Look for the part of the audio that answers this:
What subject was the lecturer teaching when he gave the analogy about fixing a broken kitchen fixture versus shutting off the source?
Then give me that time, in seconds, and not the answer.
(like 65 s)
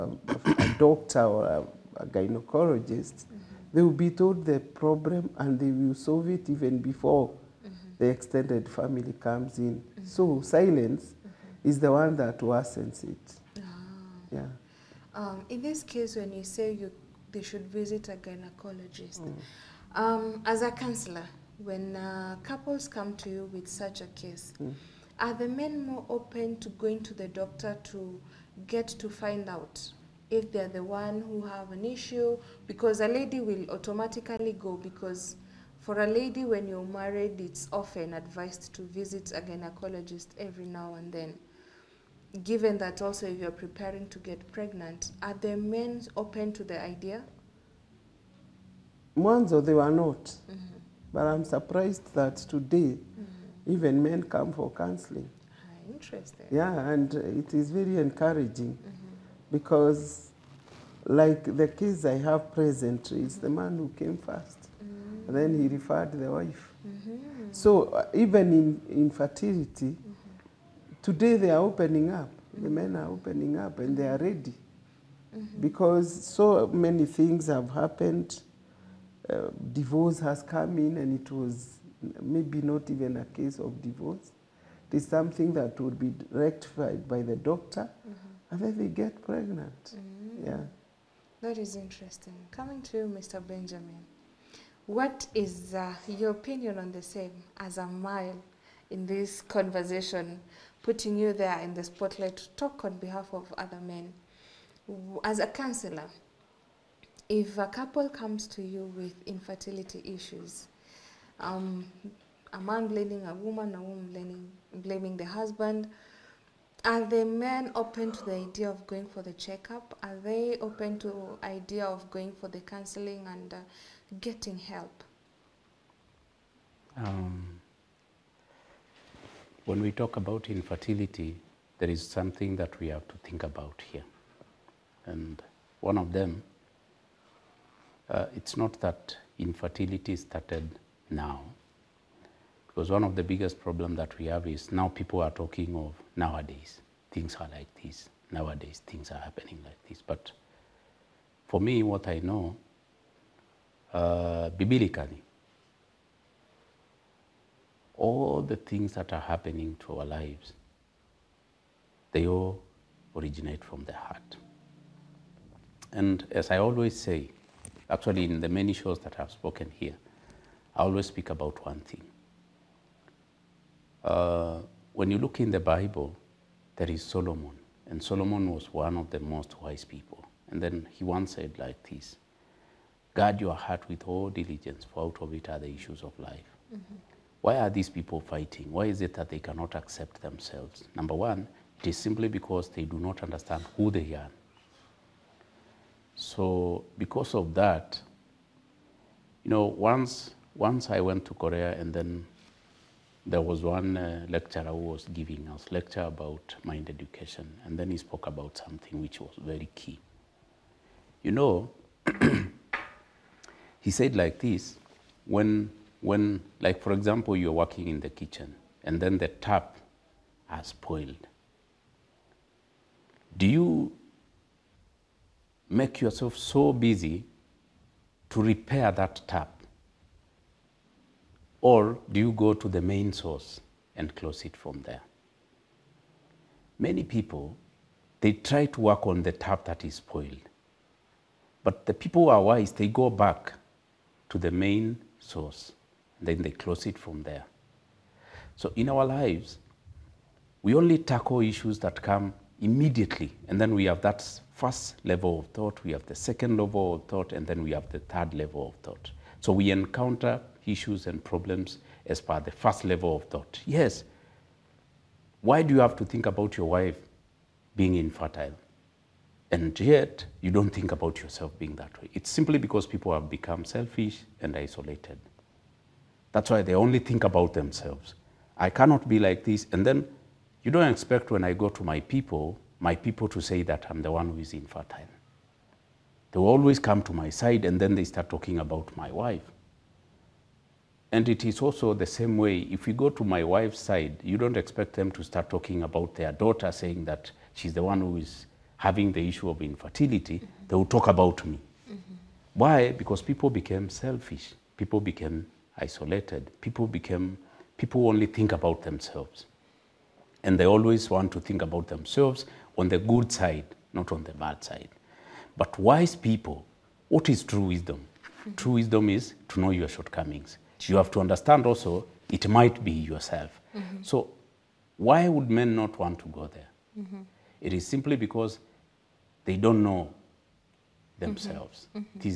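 206 s.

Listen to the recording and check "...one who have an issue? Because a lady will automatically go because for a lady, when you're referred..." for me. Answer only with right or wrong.
wrong.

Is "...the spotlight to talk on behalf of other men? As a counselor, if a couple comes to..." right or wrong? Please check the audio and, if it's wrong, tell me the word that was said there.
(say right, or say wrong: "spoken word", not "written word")
right.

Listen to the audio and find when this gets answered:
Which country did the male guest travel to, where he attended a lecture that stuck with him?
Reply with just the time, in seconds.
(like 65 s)
201 s.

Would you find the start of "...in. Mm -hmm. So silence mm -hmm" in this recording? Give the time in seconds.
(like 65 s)
9 s.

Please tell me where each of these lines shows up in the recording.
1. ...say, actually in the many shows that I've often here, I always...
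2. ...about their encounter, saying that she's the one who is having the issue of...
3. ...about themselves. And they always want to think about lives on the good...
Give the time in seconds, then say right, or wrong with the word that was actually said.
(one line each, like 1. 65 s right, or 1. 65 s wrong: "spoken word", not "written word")
1. 166 s wrong: "spoken", not "often"
2. 295 s wrong: "daughter", not "encounter"
3. 308 s wrong: "themselves", not "lives".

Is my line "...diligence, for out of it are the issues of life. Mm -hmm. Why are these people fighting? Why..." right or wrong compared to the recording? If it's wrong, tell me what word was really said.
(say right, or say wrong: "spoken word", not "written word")
right.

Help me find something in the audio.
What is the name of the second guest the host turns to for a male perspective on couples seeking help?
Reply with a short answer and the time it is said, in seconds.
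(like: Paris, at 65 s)
Mr. Benjamin, at 93 s.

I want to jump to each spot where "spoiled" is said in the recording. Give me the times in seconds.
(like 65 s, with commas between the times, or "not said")
220 s, 239 s.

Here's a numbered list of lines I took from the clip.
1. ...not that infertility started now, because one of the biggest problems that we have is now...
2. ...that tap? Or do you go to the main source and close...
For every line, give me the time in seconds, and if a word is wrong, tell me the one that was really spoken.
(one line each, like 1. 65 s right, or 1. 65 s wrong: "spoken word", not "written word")
1. 138 s right
2. 228 s right.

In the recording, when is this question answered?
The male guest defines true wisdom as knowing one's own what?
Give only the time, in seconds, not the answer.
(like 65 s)
319 s.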